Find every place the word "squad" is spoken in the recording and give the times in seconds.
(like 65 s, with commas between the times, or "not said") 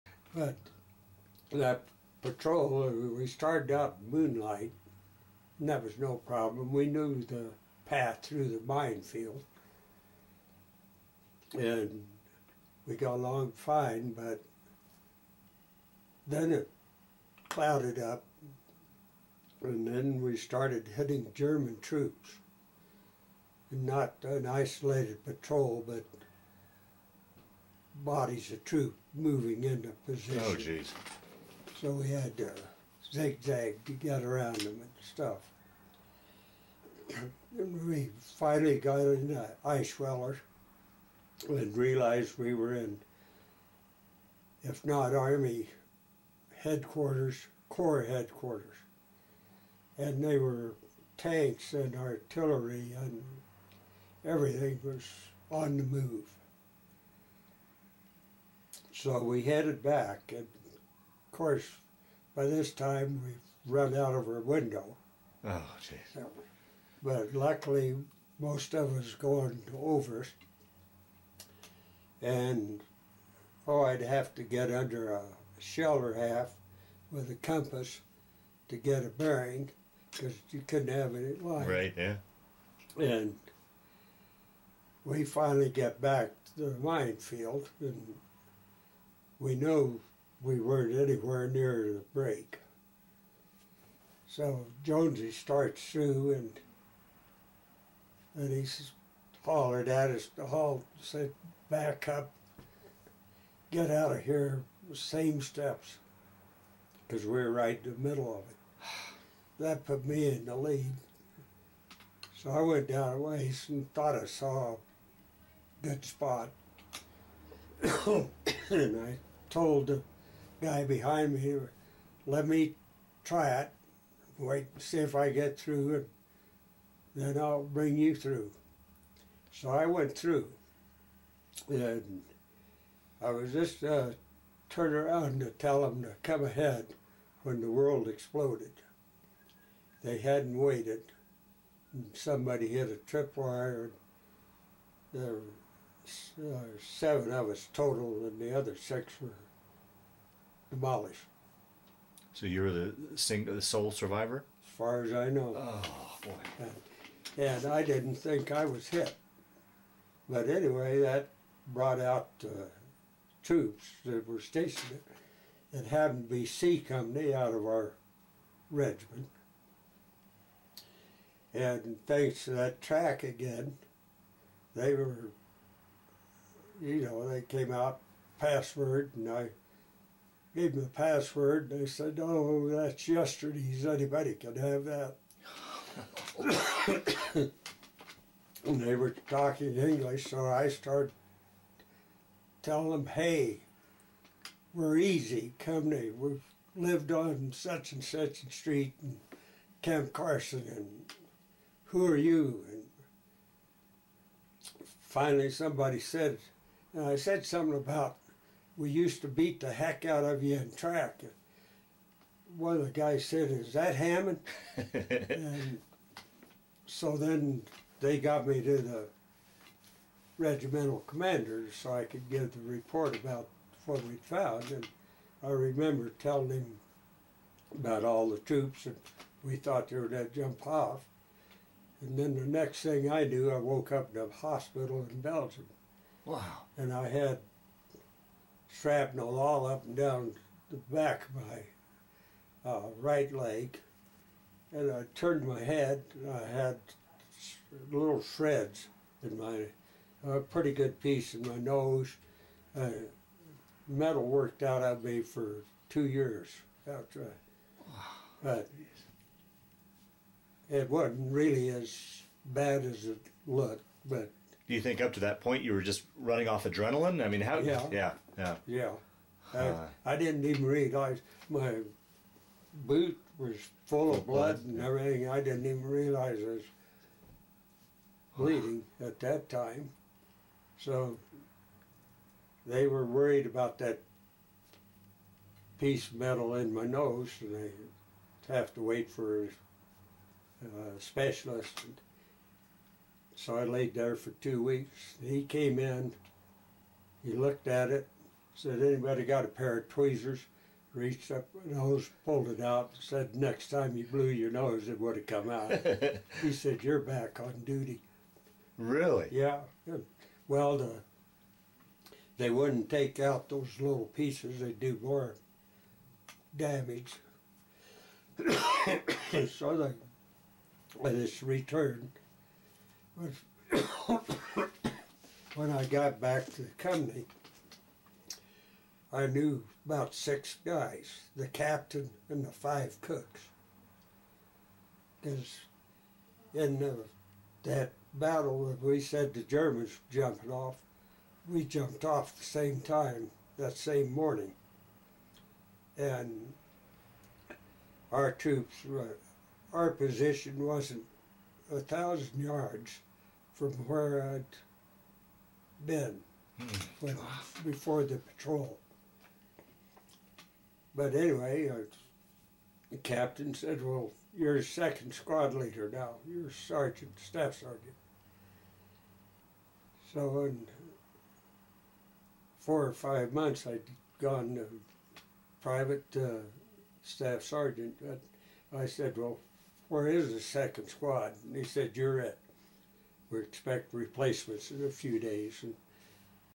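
365 s, 380 s.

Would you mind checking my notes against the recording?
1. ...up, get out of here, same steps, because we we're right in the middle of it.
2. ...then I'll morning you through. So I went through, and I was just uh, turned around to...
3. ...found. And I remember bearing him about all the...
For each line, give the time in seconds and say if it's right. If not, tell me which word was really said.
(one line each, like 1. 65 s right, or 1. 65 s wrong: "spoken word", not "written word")
1. 102 s right
2. 127 s wrong: "bring", not "morning"
3. 224 s wrong: "telling", not "bearing".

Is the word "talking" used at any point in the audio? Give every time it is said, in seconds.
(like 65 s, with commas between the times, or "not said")
189 s.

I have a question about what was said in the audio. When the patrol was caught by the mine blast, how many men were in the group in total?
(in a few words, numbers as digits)
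7.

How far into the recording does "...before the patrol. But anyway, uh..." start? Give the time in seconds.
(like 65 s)
357 s.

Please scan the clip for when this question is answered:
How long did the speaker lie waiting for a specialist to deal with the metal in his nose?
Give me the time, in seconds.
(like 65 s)
294 s.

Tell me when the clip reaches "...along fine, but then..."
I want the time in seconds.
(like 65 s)
13 s.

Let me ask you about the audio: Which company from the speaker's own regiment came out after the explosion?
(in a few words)
C Company.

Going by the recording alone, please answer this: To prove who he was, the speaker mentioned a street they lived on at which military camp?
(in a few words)
Camp Carson.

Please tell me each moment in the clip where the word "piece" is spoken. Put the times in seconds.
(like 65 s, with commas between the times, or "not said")
251 s, 285 s, 314 s.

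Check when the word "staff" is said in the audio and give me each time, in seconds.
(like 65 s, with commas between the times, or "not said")
367 s, 377 s.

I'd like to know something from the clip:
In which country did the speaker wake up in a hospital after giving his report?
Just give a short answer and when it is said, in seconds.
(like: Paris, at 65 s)
Belgium, at 235 s.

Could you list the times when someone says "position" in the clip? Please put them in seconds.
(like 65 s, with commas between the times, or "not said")
30 s, 349 s.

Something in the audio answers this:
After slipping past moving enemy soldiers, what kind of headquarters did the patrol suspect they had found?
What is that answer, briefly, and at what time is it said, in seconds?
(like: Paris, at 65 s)
Corps headquarters, at 47 s.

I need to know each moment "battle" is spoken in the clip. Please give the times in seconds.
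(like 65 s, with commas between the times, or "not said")
338 s.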